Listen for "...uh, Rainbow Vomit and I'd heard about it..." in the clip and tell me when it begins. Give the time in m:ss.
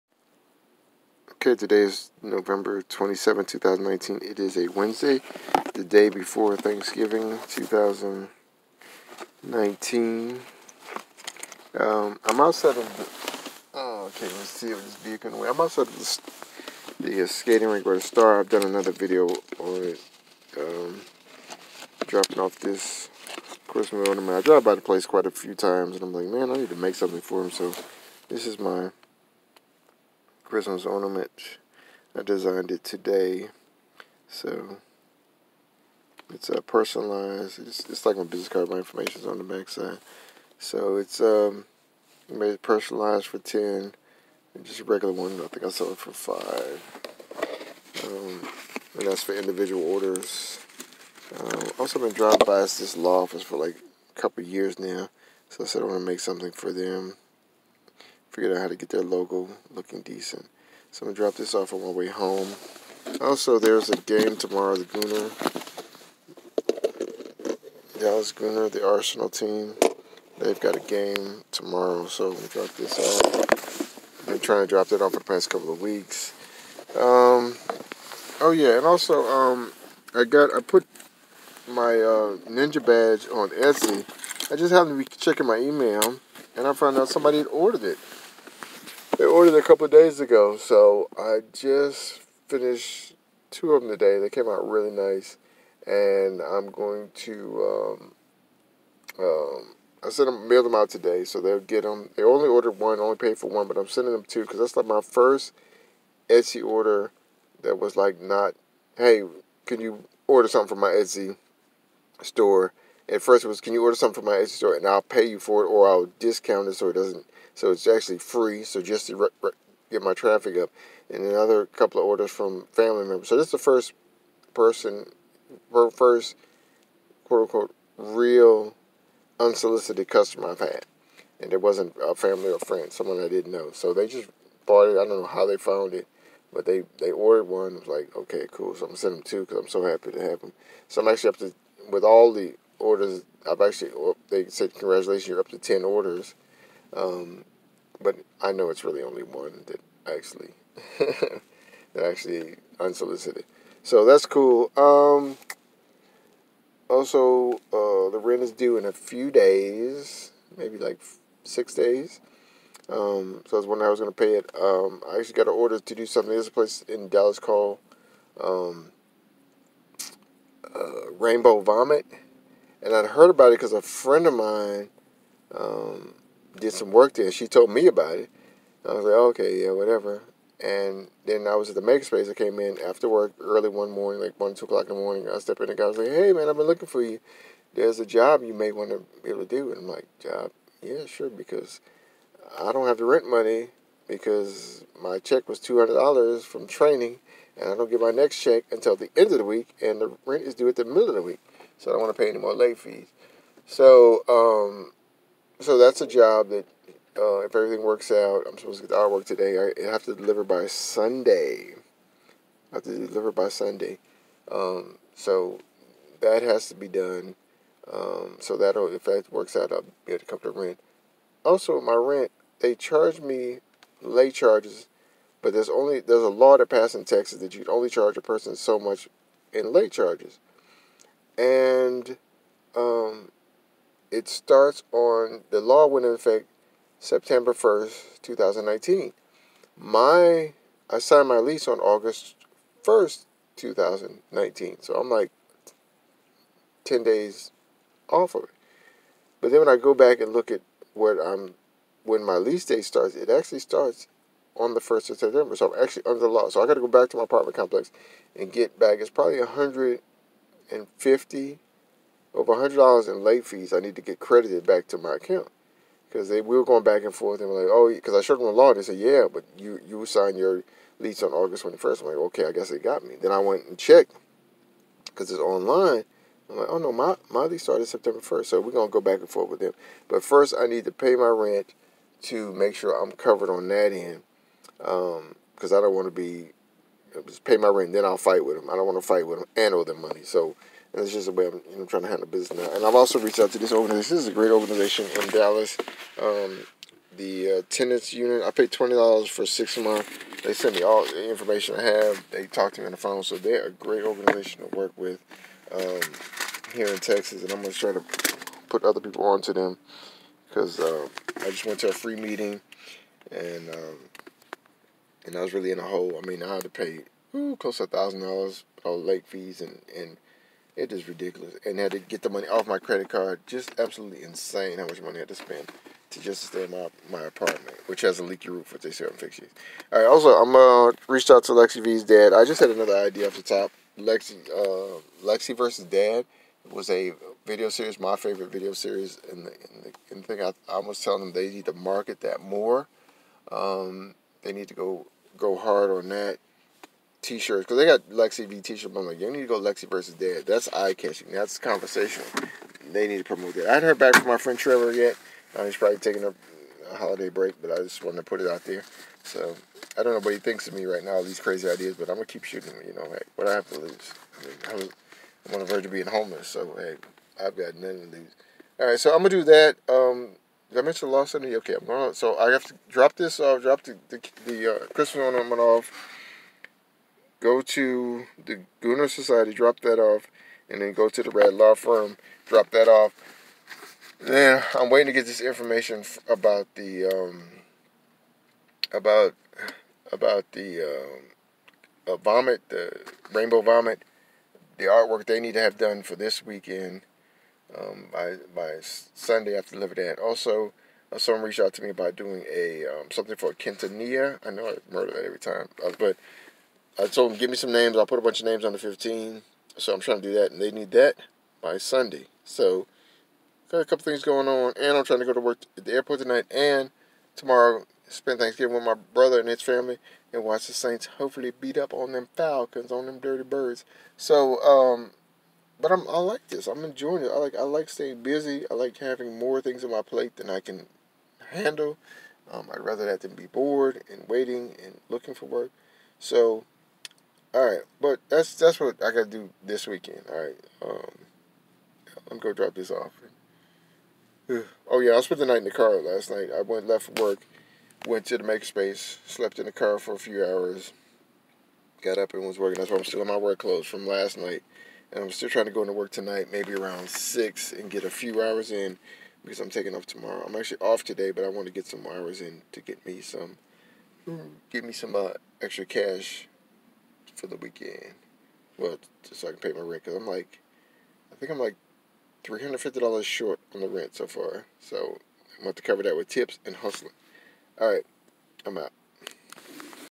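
2:50.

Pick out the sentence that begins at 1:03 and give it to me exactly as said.
Also, there's a game tomorrow, the Gunner, Dallas Gunner, the Arsenal team.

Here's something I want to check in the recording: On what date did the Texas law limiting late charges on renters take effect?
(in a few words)
September 1st, 2019.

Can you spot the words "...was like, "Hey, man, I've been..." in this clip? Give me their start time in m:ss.
3:05.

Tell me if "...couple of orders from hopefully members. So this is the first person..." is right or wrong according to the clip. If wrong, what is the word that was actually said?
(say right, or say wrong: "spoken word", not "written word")
wrong: "family", not "hopefully".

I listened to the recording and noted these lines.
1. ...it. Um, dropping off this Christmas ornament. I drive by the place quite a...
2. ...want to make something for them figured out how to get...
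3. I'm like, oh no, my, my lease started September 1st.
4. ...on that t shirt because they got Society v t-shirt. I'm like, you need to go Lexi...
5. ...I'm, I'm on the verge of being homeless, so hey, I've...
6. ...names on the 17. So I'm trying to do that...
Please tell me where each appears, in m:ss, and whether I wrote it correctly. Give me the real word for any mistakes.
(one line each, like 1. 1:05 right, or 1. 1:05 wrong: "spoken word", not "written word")
1. 0:19 right
2. 0:55 right
3. 4:36 right
4. 5:45 wrong: "Lexi", not "Society"
5. 6:04 right
6. 6:48 wrong: "15", not "17".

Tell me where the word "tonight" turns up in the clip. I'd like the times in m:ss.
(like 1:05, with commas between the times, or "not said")
6:56, 7:36.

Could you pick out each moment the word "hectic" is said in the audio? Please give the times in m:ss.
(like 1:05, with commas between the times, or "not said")
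not said.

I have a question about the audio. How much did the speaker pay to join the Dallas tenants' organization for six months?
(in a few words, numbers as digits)
$20.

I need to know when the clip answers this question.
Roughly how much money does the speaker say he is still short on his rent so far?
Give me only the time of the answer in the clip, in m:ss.
7:52.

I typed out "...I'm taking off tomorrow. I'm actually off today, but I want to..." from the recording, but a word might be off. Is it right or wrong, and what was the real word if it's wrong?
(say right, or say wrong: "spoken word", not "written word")
right.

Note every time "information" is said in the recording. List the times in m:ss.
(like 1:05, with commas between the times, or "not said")
0:38, 5:01, 6:25.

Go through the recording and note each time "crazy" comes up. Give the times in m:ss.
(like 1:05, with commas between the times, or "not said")
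6:01.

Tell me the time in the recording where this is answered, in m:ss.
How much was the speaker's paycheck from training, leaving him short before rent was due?
3:15.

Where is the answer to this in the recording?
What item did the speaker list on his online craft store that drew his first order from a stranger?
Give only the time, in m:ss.
1:22.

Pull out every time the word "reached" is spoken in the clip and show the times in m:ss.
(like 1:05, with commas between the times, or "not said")
4:53, 5:31, 6:41.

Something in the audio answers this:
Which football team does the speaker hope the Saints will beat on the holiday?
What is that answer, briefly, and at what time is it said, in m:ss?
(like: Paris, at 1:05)
Falcons, at 7:02.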